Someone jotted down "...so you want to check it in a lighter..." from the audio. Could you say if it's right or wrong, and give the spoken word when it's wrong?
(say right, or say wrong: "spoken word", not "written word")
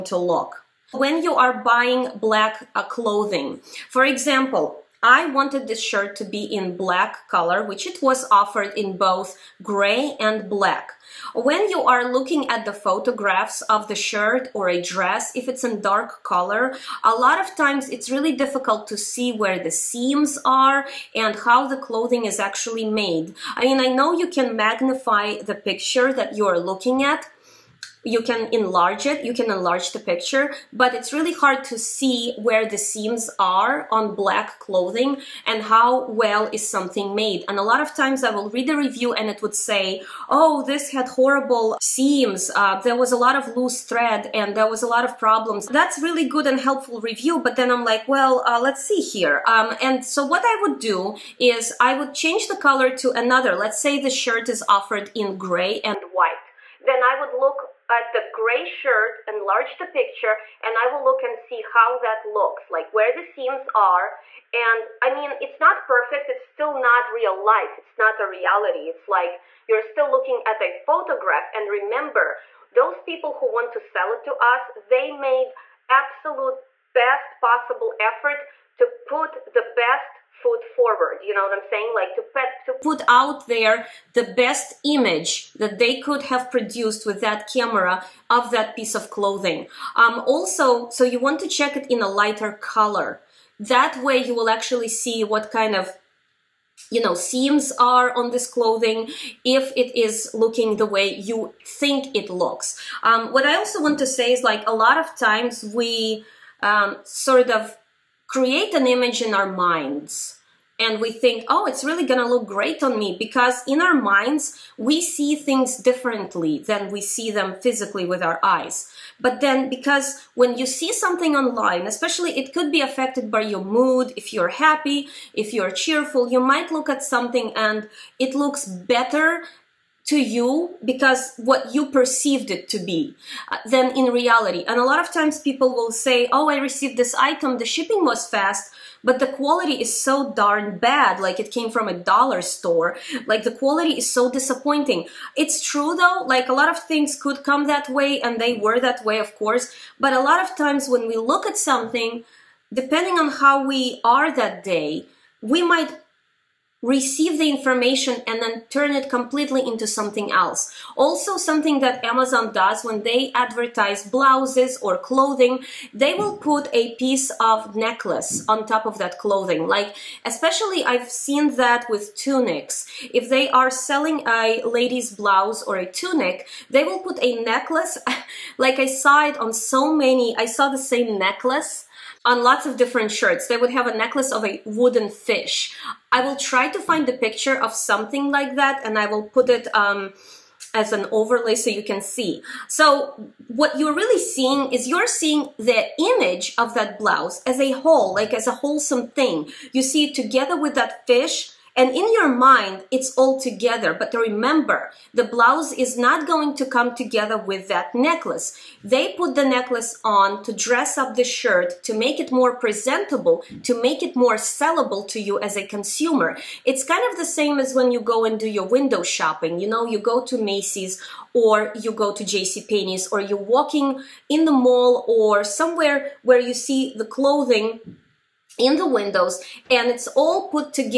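right.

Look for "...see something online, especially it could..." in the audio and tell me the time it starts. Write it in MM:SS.
02:00.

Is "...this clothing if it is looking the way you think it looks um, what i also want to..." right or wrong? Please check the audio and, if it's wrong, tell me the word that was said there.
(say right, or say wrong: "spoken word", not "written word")
right.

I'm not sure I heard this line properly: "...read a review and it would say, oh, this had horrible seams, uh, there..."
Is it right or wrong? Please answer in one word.
right.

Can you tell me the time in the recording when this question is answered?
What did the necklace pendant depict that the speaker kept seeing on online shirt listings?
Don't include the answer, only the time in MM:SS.
03:04.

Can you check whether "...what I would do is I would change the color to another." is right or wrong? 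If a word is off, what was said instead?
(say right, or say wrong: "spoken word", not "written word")
right.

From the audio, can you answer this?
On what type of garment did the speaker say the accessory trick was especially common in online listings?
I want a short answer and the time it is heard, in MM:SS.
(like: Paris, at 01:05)
tunics, at 02:52.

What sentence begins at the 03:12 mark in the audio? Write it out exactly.
So what you're really seeing is you're seeing the image of that blouse as a whole, like as a wholesome thing.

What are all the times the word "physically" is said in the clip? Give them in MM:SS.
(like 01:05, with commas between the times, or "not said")
01:57.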